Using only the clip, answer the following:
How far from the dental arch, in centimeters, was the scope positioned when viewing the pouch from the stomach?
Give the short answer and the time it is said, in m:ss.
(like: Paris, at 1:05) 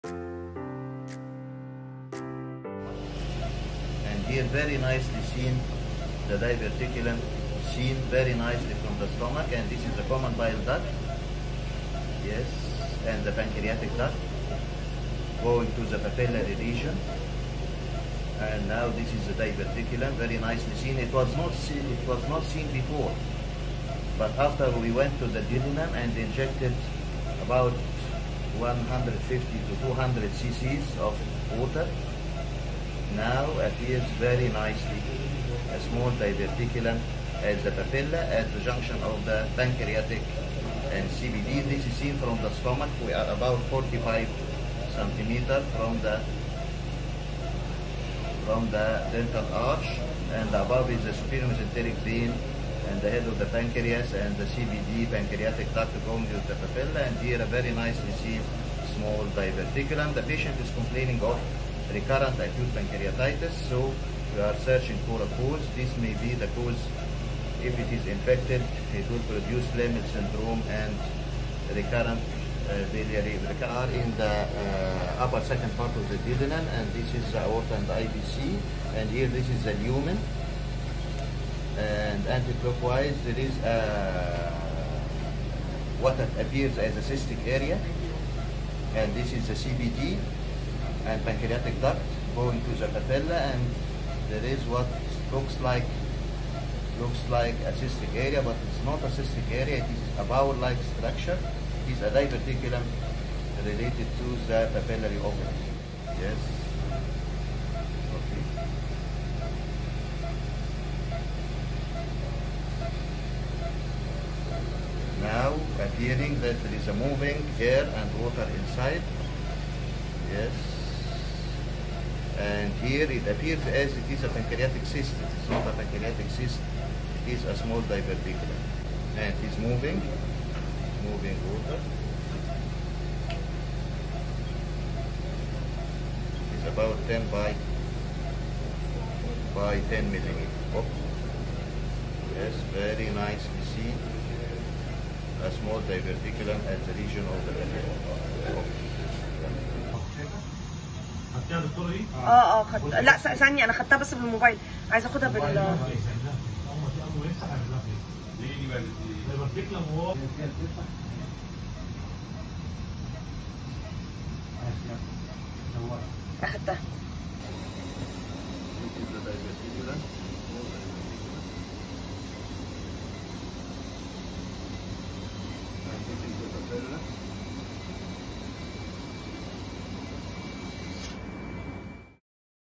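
45 centimeters, at 0:43.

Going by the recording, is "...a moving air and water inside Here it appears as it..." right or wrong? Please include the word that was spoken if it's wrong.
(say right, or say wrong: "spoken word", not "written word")
right.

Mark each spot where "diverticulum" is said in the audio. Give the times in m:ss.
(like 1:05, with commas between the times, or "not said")
0:06, 0:19, 0:36, 0:59, 1:42, 2:07, 2:25.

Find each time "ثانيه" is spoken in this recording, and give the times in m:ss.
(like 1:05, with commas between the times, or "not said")
2:33.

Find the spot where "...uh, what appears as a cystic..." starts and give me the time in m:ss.
1:24.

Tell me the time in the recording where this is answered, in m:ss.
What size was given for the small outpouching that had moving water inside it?
2:17.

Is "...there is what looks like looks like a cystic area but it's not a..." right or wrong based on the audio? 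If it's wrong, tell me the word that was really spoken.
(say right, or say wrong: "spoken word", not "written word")
right.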